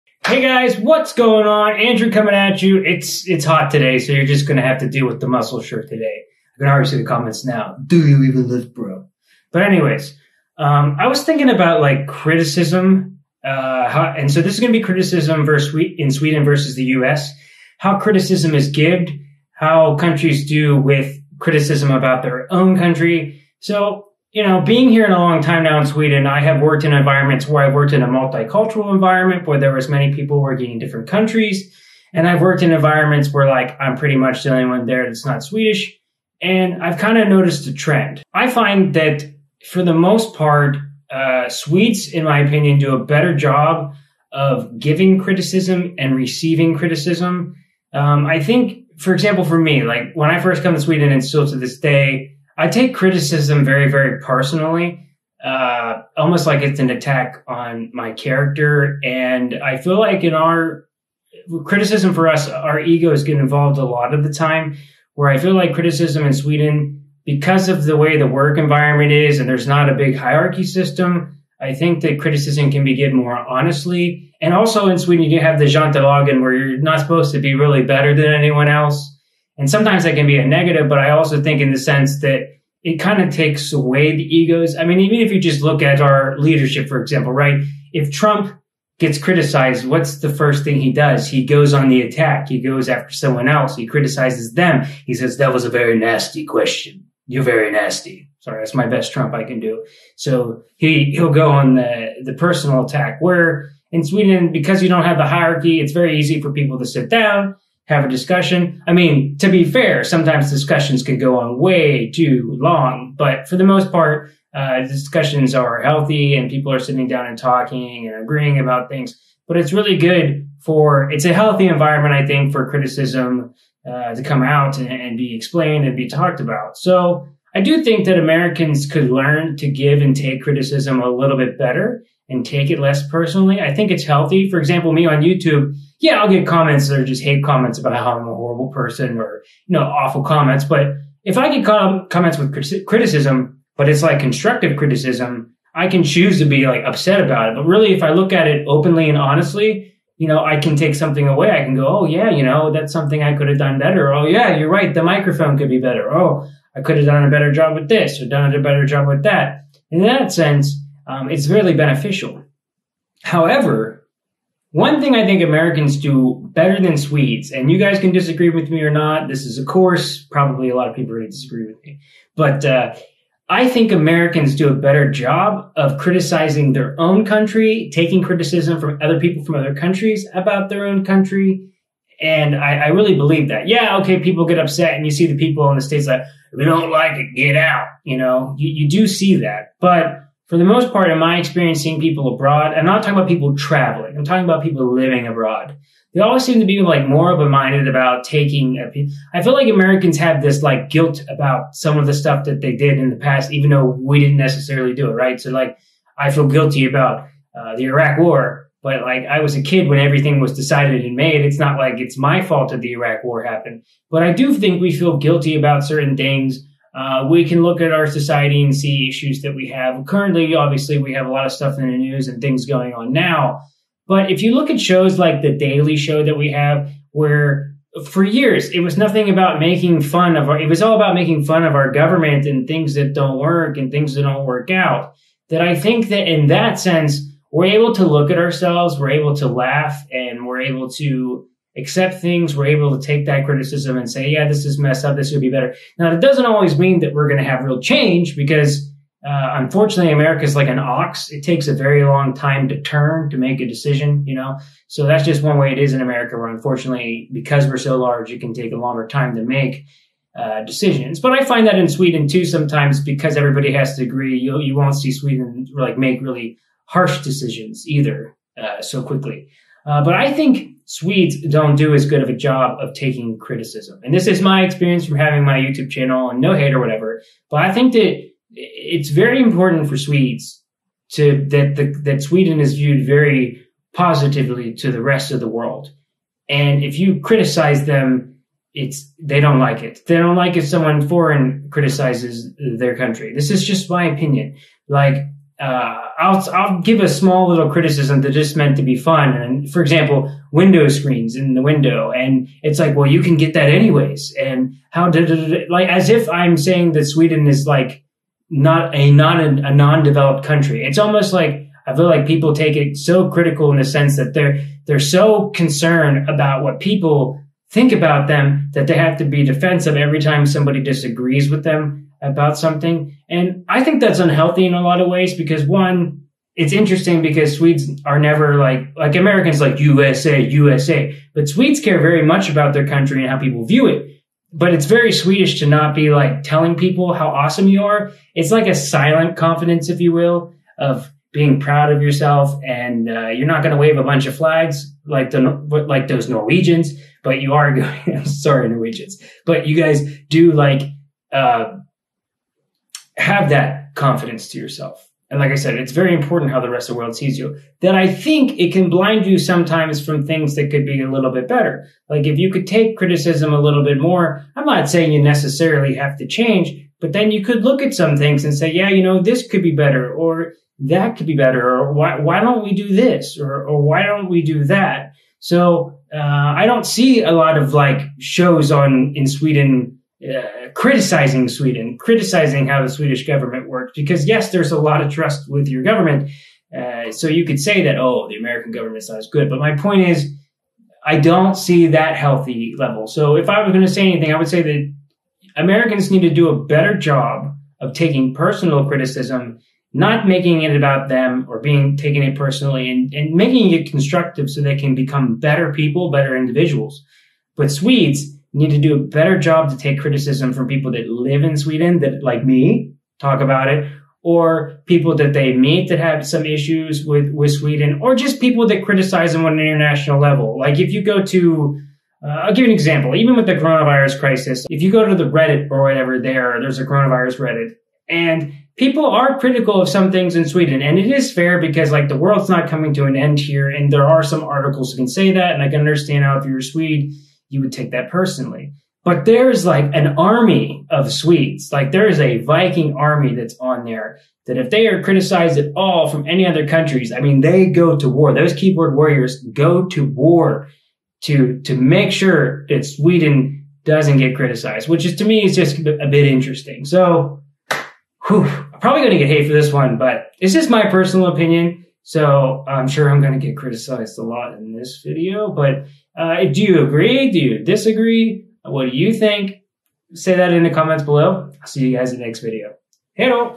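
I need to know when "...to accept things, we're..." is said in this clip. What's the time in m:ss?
4:00.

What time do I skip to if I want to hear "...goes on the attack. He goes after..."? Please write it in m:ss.
1:31.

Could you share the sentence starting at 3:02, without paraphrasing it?
And I, I really believe that.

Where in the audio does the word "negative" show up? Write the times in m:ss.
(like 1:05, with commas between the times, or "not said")
1:20.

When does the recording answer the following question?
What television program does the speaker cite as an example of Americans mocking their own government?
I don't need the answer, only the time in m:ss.
3:45.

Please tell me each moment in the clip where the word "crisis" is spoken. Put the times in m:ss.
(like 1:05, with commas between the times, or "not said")
7:04.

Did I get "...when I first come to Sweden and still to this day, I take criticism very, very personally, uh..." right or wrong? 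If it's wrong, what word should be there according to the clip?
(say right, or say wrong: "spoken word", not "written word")
right.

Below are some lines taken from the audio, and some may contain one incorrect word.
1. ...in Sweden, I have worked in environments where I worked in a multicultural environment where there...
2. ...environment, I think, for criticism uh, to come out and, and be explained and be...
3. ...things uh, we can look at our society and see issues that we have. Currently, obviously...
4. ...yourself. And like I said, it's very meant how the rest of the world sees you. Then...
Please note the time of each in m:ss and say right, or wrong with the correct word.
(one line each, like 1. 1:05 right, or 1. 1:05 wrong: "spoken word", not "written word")
1. 0:25 right
2. 2:01 right
3. 3:36 right
4. 5:54 wrong: "important", not "meant".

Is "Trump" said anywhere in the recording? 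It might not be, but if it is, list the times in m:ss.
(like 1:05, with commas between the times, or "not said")
1:28, 1:39.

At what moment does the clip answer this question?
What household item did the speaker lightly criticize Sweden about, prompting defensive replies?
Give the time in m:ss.
5:00.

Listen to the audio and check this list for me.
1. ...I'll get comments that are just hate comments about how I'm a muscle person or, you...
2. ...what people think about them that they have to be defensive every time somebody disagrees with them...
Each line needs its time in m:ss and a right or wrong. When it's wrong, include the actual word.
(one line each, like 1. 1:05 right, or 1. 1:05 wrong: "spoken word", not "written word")
1. 2:16 wrong: "horrible", not "muscle"
2. 5:16 right.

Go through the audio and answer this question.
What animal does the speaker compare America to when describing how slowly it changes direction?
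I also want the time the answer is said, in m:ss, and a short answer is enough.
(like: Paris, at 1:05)
An ox, at 4:10.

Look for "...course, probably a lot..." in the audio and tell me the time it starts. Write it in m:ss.
2:49.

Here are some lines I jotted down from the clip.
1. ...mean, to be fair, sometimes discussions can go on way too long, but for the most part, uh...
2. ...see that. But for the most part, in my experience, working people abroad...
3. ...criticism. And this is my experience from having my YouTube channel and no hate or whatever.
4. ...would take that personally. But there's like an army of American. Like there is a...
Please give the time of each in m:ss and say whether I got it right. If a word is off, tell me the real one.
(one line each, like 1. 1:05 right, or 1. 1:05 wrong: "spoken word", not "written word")
1. 1:48 right
2. 3:09 wrong: "seeing", not "working"
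3. 4:33 right
4. 7:17 wrong: "Swedes", not "American".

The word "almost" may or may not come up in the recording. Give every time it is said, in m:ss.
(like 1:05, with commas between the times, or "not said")
0:56, 5:10.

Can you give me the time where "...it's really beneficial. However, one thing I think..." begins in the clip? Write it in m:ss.
2:41.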